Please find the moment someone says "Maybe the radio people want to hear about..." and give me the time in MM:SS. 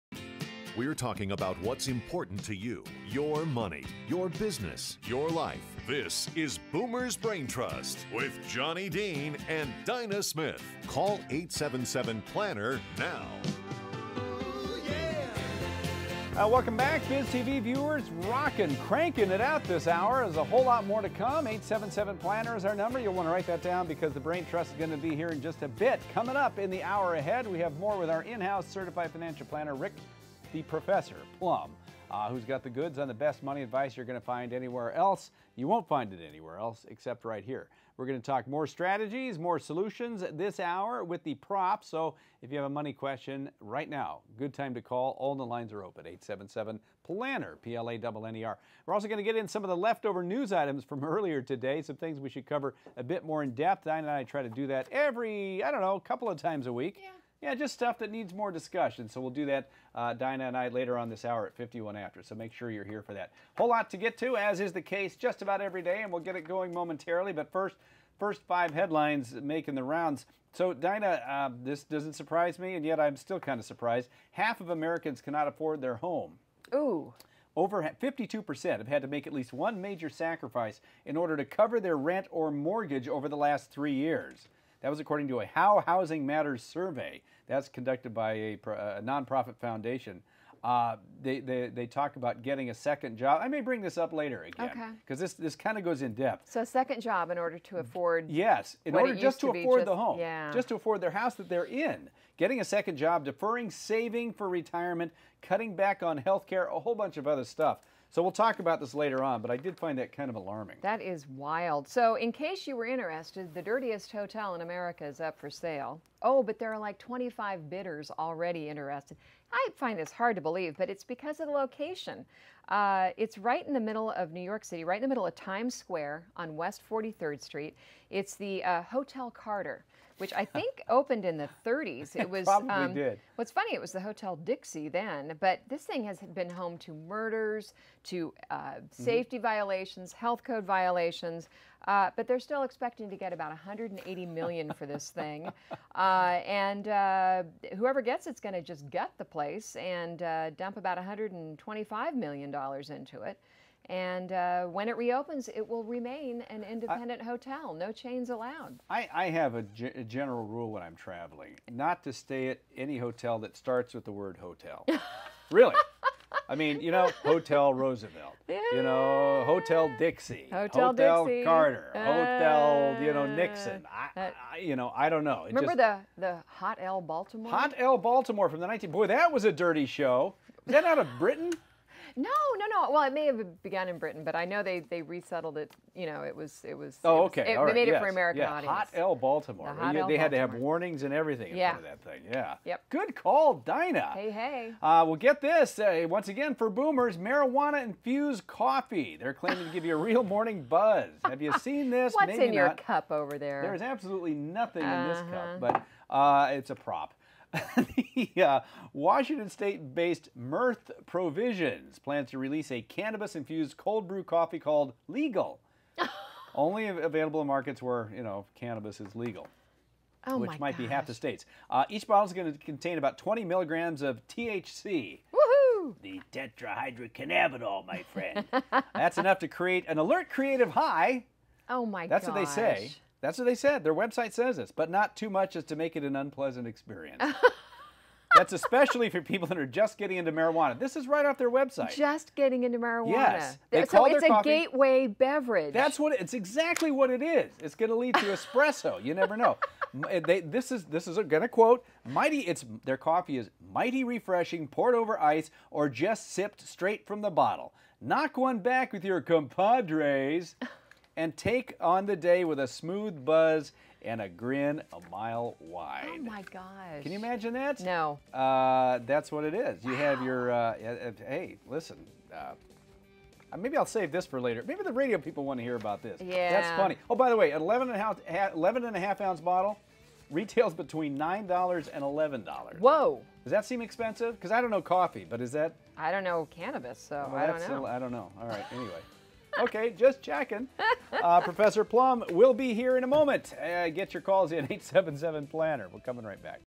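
04:34.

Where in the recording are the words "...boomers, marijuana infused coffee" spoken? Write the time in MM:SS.
03:16.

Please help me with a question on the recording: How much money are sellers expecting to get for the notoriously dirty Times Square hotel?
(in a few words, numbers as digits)
180 million.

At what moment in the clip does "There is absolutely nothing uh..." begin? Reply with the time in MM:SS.
03:23.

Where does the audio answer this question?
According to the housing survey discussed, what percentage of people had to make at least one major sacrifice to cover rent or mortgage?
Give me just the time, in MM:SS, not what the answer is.
01:18.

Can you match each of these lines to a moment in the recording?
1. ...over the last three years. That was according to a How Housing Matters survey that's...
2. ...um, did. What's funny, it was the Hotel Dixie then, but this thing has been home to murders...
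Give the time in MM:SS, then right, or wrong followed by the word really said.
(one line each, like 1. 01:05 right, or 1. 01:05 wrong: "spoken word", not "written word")
1. 01:23 right
2. 02:12 right.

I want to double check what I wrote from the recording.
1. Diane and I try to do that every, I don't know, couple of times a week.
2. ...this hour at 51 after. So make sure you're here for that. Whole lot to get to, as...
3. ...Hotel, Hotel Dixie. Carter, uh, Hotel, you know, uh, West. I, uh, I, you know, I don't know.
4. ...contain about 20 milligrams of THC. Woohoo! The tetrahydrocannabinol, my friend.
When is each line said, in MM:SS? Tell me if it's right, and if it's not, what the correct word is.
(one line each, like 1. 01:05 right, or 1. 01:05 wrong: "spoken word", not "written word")
1. 00:53 right
2. 01:01 right
3. 02:50 wrong: "Nixon", not "West"
4. 03:42 right.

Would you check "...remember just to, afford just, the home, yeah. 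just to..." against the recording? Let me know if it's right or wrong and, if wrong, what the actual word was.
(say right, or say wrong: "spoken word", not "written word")
wrong: "order", not "remember".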